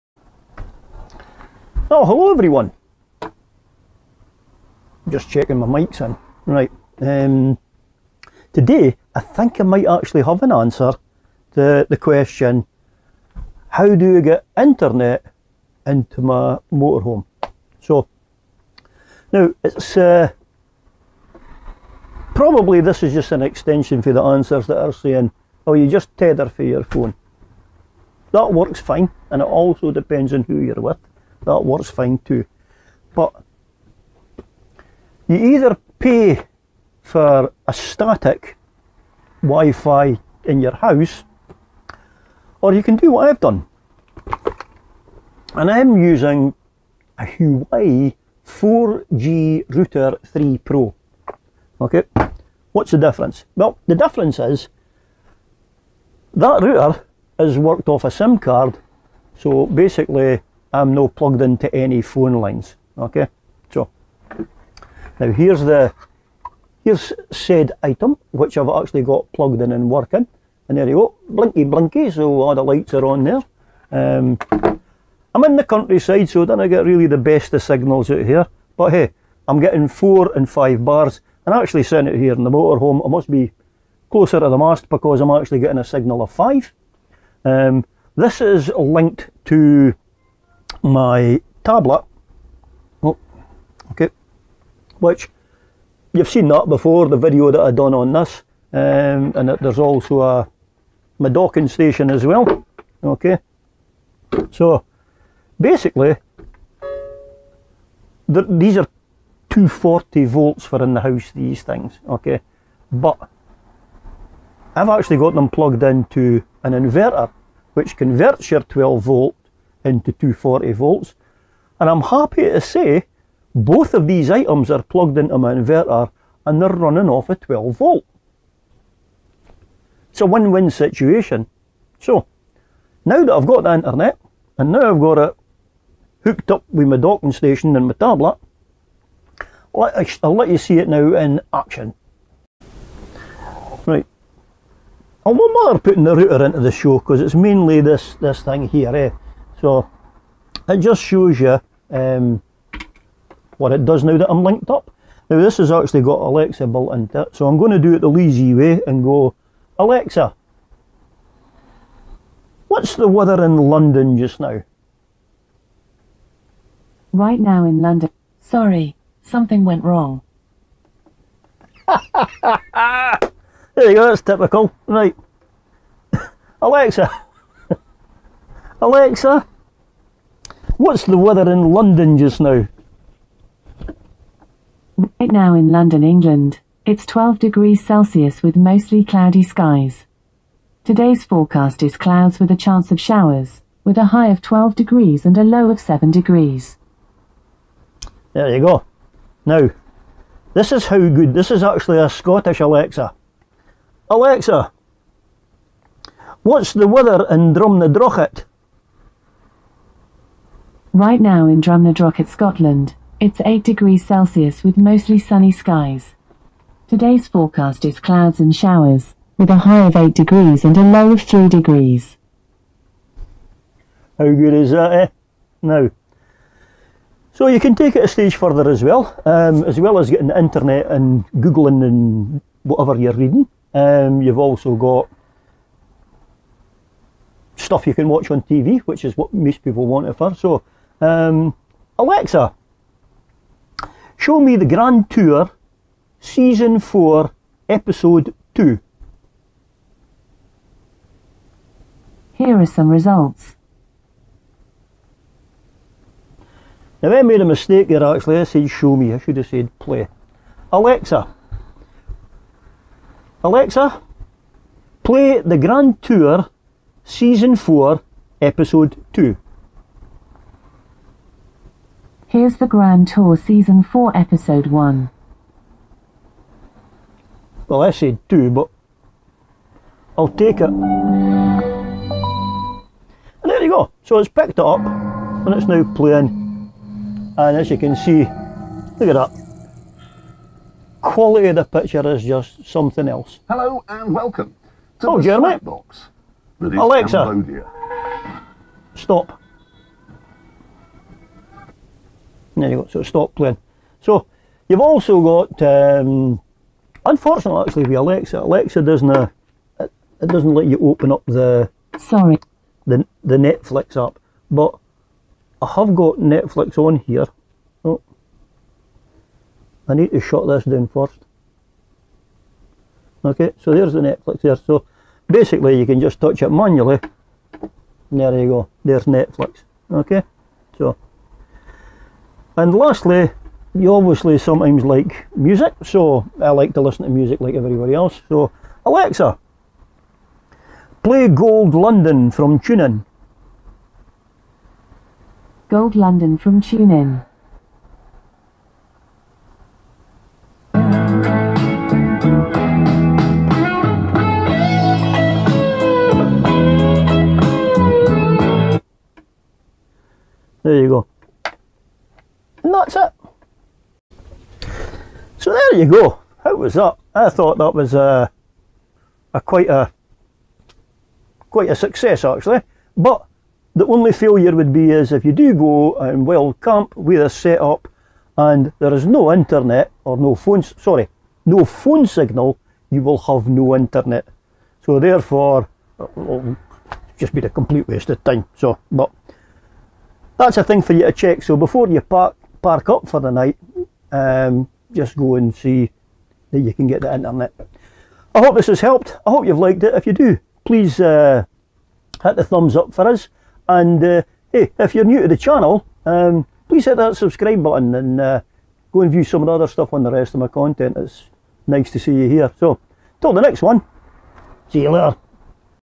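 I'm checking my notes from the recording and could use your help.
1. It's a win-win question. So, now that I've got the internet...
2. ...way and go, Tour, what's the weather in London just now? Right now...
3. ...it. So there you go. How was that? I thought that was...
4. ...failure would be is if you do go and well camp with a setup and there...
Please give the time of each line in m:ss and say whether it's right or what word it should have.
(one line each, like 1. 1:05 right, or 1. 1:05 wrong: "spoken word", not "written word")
1. 2:10 wrong: "situation", not "question"
2. 2:38 wrong: "Alexa", not "Tour"
3. 6:02 right
4. 6:14 right.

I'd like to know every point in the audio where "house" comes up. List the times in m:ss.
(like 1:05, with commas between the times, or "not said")
0:40, 1:51.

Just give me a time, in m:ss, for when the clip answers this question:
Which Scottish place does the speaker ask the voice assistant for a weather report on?
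3:27.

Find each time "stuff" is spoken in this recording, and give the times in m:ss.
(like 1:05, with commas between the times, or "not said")
3:57, 6:49.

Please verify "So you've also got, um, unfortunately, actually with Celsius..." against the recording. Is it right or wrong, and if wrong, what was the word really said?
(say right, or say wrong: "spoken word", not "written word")
wrong: "Alexa", not "Celsius".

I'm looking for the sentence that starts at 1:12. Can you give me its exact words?
So all the lights are on there.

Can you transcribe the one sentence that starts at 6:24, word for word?
So therefore, it'll uh, just be a complete waste of time.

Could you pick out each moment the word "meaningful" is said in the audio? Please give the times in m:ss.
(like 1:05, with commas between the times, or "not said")
not said.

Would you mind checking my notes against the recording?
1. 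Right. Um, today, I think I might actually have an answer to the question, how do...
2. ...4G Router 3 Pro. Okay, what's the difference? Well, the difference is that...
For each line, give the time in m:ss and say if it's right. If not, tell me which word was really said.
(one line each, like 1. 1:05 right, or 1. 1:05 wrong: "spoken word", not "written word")
1. 0:06 right
2. 0:48 right.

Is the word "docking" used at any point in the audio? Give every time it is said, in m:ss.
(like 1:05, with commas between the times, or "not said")
1:41, 2:16.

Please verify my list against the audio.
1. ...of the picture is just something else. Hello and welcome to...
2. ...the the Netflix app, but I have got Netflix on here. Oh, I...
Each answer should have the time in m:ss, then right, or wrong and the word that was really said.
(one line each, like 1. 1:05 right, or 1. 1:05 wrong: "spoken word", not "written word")
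1. 4:51 right
2. 5:12 right.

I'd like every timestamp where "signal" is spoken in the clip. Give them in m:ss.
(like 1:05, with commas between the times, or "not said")
1:17, 1:25, 6:22.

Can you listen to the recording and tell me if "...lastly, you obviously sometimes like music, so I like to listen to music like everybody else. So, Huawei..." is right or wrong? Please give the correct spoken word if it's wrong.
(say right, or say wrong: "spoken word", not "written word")
wrong: "Alexa", not "Huawei".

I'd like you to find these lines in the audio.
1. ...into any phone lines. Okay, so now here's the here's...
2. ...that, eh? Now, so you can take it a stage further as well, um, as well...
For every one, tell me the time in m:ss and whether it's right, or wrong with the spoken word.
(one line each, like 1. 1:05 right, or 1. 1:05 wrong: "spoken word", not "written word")
1. 1:01 right
2. 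3:44 right.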